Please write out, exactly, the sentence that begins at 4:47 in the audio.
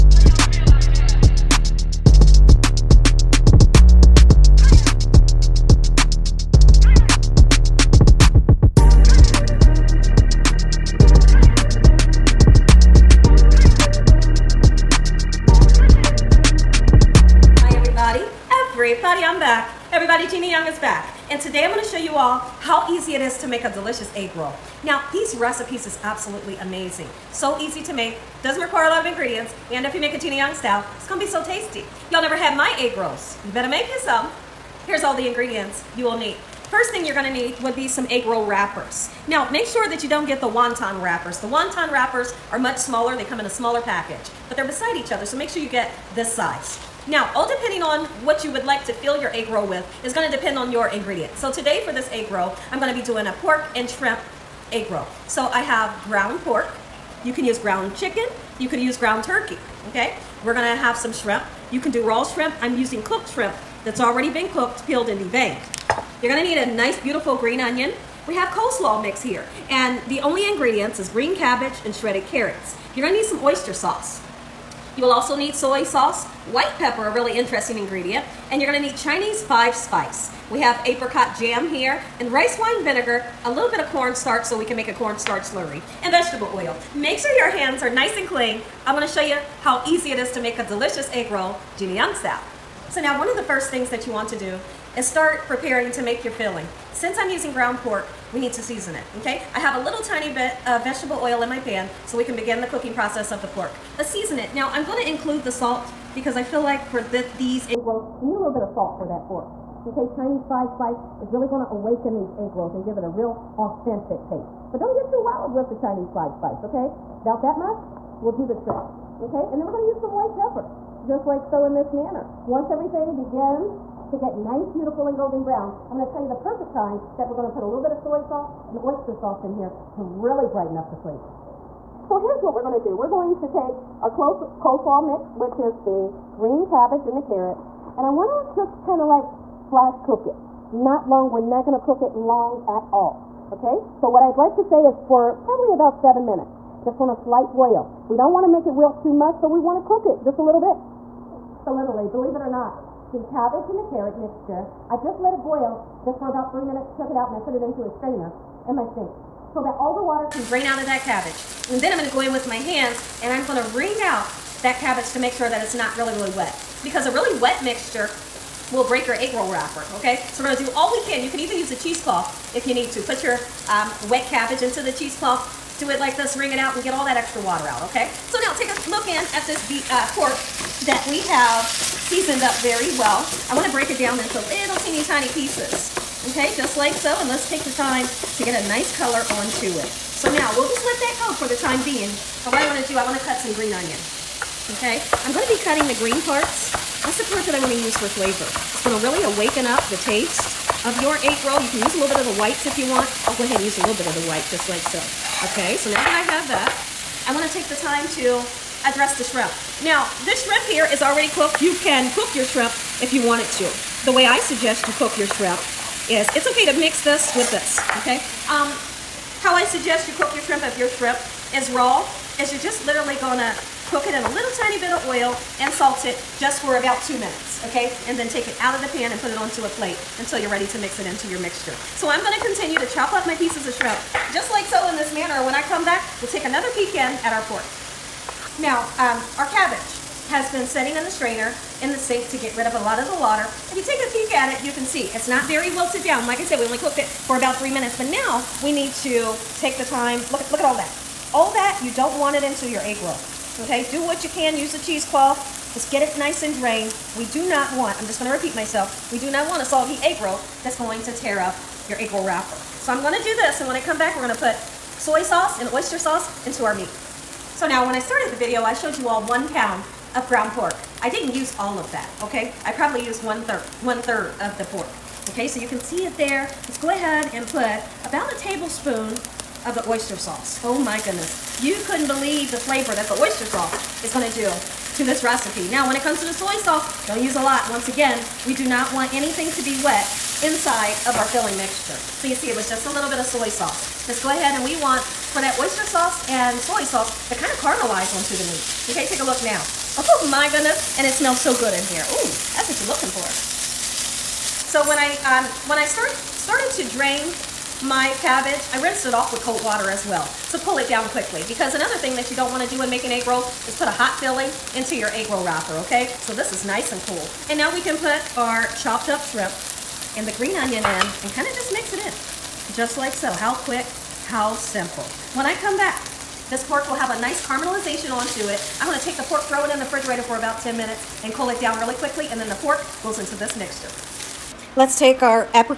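Once again, we do not want anything to be wet inside of our filling mixture.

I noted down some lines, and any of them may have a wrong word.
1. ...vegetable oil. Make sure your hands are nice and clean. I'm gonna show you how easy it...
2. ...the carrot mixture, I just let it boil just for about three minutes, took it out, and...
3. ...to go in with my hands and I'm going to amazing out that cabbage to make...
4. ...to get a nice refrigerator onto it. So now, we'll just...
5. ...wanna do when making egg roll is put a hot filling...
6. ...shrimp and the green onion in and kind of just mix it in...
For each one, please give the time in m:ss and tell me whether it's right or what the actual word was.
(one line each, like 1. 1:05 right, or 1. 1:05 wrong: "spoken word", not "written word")
1. 1:26 right
2. 2:33 right
3. 2:42 wrong: "wring", not "amazing"
4. 3:08 wrong: "color", not "refrigerator"
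5. 5:12 right
6. 5:19 right.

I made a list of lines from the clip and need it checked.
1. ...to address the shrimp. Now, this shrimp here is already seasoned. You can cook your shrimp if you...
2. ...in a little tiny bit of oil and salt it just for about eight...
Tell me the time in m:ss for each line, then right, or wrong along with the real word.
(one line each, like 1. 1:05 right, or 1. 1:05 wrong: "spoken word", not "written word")
1. 3:28 wrong: "cooked", not "seasoned"
2. 3:44 wrong: "two", not "eight".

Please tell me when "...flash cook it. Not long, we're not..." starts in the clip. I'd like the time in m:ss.
2:19.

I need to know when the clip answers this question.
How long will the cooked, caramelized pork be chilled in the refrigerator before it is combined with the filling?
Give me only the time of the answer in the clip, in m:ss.
5:30.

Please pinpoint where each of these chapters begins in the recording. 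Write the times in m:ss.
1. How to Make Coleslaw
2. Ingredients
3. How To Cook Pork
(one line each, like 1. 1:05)
1. 2:15
2. 0:35
3. 1:45.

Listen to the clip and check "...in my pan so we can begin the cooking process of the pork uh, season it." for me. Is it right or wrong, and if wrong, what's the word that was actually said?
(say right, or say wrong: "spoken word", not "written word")
right.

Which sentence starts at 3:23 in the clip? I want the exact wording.
I'll go ahead and use a little bit of the white just like so.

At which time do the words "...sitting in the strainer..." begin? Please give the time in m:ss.
4:00.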